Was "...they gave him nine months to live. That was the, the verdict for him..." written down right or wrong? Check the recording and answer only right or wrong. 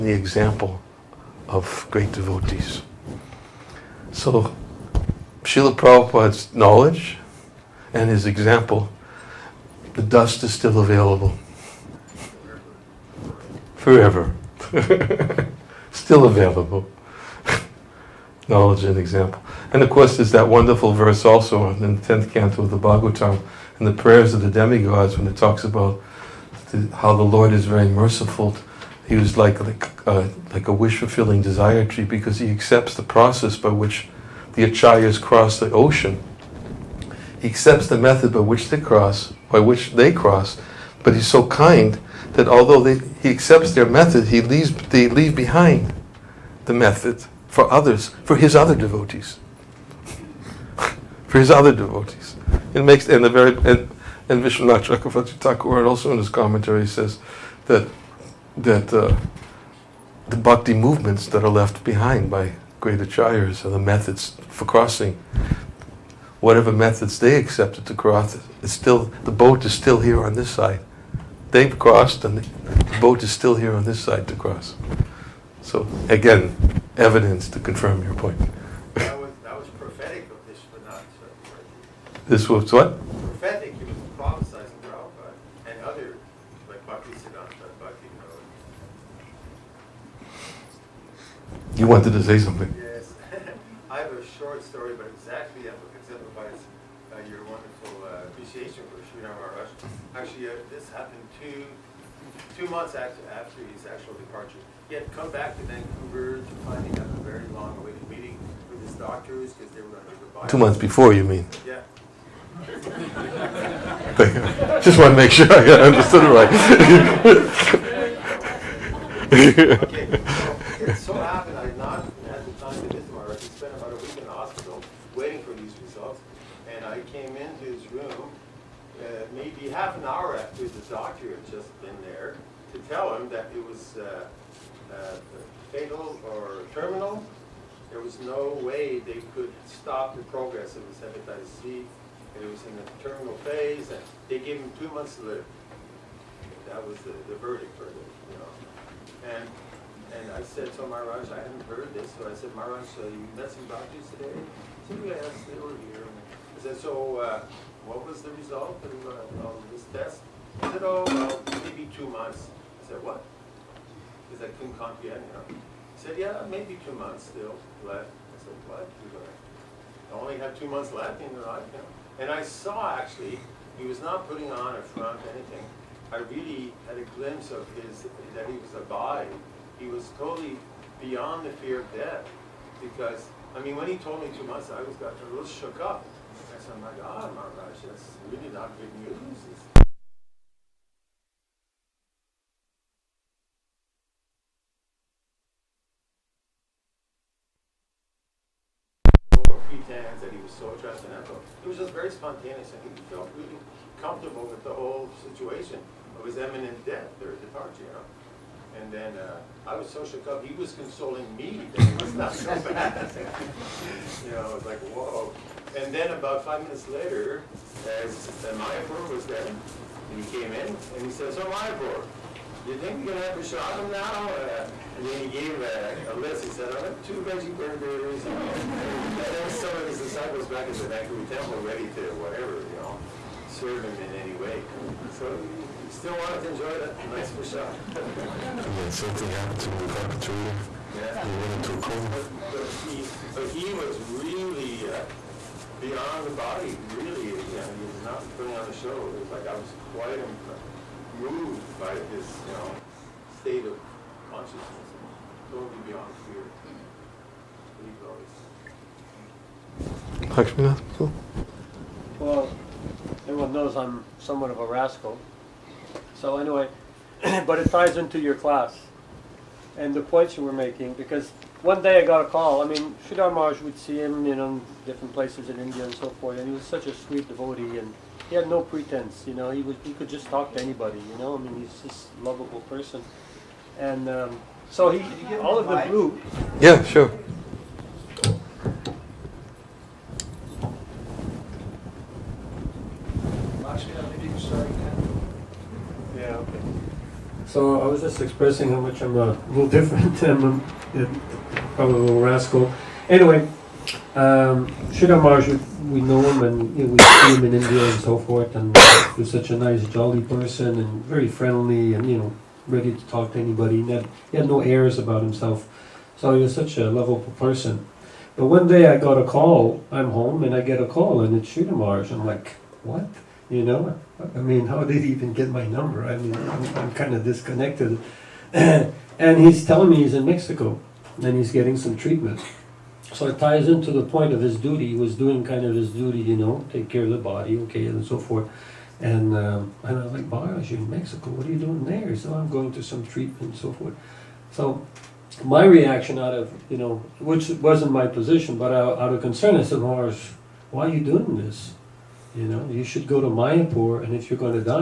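wrong.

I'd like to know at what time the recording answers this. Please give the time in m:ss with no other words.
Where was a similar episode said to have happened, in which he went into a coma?
3:59.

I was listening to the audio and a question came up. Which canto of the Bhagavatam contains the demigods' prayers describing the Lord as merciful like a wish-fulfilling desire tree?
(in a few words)
10th canto.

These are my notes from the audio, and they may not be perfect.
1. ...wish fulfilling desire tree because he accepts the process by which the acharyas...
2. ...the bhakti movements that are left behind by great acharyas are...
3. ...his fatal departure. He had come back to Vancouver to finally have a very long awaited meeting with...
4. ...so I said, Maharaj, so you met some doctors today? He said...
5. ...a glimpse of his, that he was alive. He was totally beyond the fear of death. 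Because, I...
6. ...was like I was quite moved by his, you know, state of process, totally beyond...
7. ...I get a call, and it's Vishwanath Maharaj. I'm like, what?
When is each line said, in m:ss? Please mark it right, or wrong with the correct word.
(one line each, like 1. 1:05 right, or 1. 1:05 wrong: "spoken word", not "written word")
1. 0:30 right
2. 1:00 right
3. 1:43 wrong: "actual", not "fatal"
4. 2:32 right
5. 2:56 right
6. 4:09 wrong: "consciousness", not "process"
7. 5:20 wrong: "Sridhar", not "Vishwanath".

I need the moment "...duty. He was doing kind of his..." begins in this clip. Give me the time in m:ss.
5:34.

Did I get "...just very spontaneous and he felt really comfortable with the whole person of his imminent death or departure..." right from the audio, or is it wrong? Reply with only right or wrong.
wrong.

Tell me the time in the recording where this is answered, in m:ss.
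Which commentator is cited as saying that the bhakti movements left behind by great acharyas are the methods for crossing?
0:54.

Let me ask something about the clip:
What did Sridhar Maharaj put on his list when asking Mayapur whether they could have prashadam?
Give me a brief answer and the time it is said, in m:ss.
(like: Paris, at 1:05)
2 veggie burgers, at 3:47.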